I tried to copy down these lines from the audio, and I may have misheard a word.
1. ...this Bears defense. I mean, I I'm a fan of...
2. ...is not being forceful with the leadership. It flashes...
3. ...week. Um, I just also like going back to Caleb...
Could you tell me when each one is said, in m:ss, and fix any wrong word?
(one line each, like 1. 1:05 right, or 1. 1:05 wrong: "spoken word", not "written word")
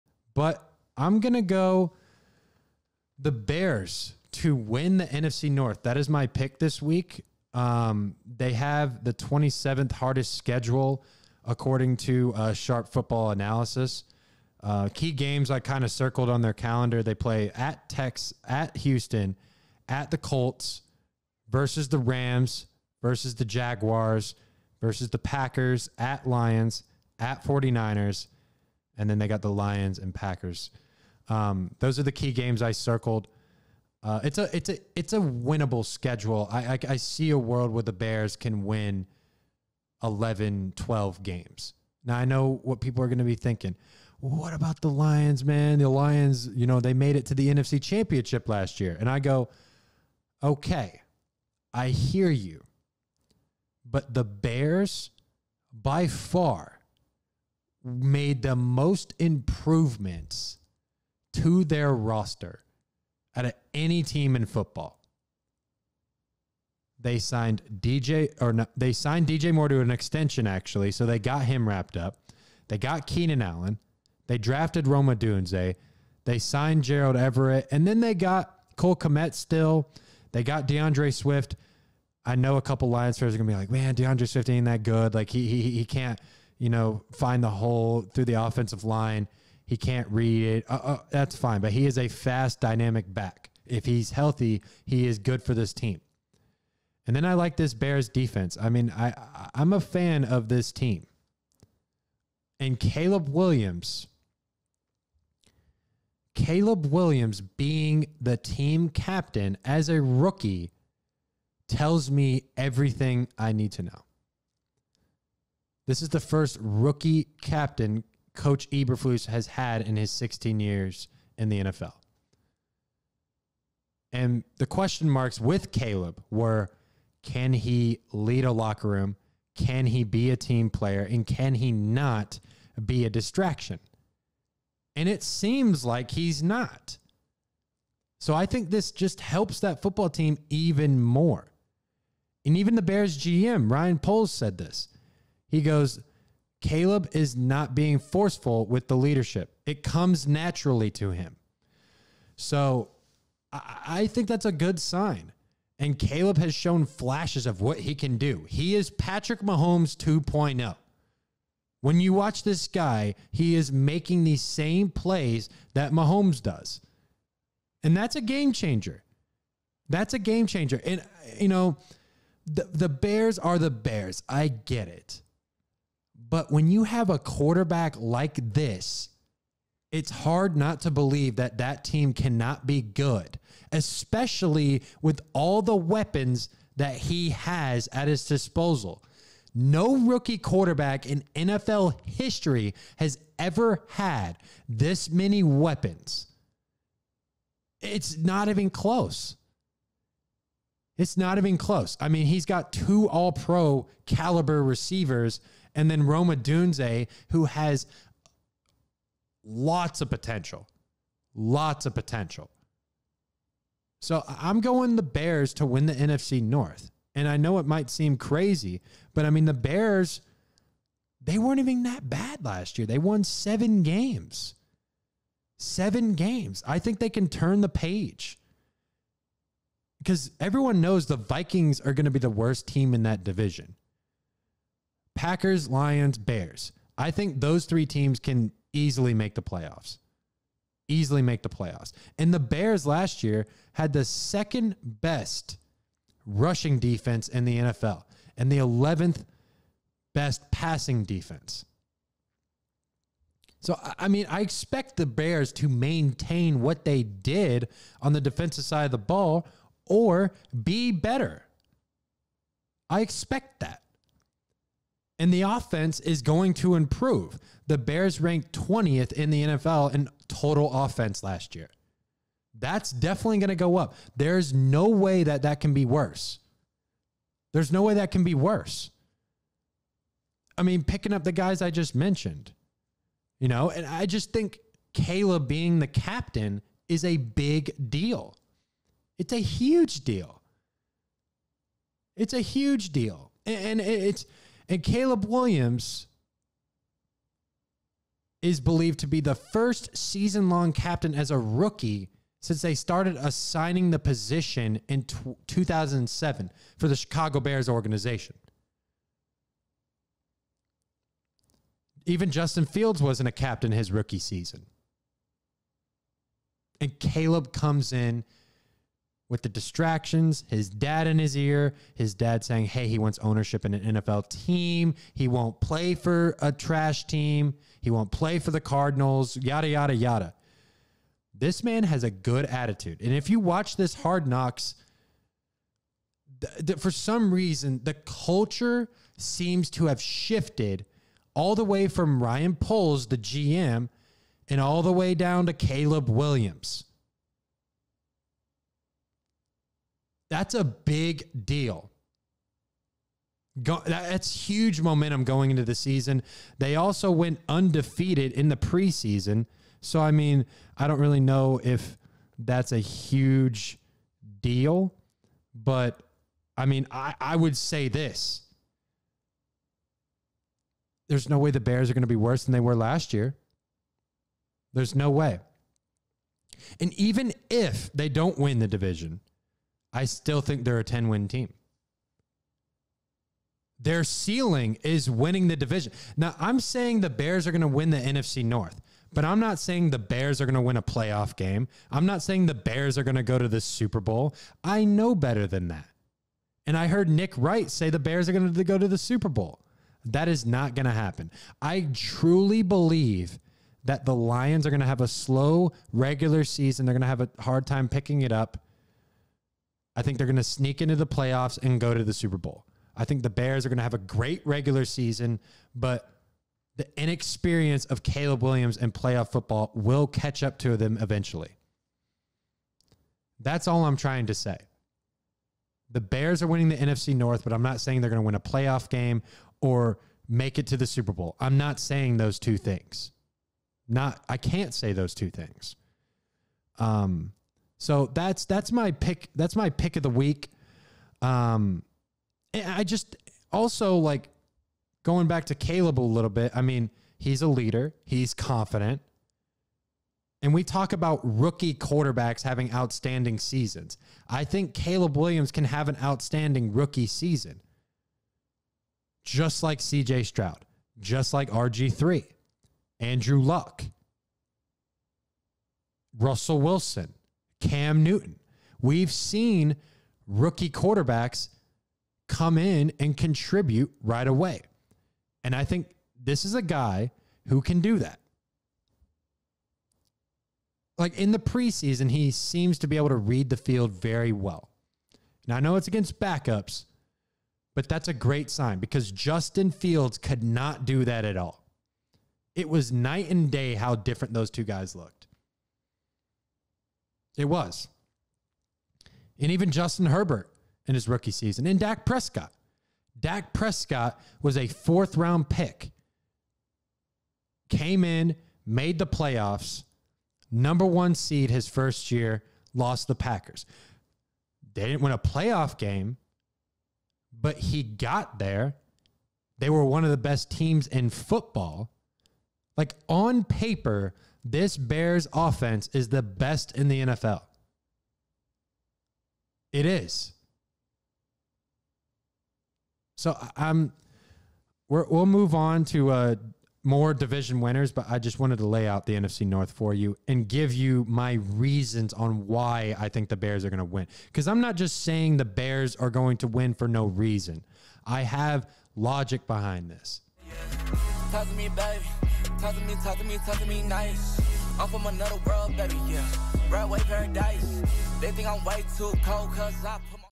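1. 1:37 right
2. 2:27 wrong: "comes", not "flashes"
3. 7:20 right.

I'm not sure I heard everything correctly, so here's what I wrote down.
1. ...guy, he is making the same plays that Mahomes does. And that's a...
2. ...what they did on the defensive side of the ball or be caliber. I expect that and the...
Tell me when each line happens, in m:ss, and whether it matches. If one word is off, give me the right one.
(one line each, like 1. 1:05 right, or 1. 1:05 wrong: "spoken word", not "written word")
1. 2:42 right
2. 4:16 wrong: "better", not "caliber".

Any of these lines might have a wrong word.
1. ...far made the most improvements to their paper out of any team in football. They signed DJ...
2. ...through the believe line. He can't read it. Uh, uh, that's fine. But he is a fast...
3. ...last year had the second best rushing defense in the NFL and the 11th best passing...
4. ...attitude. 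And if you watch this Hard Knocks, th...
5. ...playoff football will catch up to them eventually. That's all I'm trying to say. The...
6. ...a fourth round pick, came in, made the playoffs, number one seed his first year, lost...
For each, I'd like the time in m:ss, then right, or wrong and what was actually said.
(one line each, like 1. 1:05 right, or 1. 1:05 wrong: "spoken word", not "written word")
1. 0:56 wrong: "roster", not "paper"
2. 1:28 wrong: "offensive", not "believe"
3. 4:02 right
4. 5:32 right
5. 6:58 right
6. 8:24 right.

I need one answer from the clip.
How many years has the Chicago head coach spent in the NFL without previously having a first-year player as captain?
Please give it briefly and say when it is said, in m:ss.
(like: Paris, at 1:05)
16, at 2:00.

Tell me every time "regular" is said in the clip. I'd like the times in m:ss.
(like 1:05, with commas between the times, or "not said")
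6:45, 6:54.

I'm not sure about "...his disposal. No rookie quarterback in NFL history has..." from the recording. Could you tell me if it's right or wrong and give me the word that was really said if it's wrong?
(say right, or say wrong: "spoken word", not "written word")
right.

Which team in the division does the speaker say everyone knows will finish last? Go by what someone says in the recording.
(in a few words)
Vikings.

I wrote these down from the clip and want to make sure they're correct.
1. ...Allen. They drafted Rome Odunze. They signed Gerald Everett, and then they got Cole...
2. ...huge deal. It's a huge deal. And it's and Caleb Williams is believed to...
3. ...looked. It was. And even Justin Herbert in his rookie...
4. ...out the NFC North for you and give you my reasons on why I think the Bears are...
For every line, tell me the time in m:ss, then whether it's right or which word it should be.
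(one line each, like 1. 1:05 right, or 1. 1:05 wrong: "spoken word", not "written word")
1. 1:13 right
2. 4:49 right
3. 8:14 right
4. 8:58 right.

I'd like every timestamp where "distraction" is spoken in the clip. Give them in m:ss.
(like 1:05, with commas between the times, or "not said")
2:13, 5:19.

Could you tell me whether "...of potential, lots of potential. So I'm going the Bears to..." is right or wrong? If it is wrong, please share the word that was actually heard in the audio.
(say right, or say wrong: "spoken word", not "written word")
right.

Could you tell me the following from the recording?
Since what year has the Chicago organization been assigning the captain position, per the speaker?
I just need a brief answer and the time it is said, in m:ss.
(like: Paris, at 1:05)
2007, at 5:05.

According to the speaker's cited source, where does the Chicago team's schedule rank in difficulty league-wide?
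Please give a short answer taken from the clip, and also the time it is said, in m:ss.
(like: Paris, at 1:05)
27th, at 0:09.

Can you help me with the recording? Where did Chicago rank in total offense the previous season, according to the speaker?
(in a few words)
20th.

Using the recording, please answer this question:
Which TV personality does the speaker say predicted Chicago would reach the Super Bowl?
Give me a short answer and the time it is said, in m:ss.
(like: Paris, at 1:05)
Nick Wright, at 6:37.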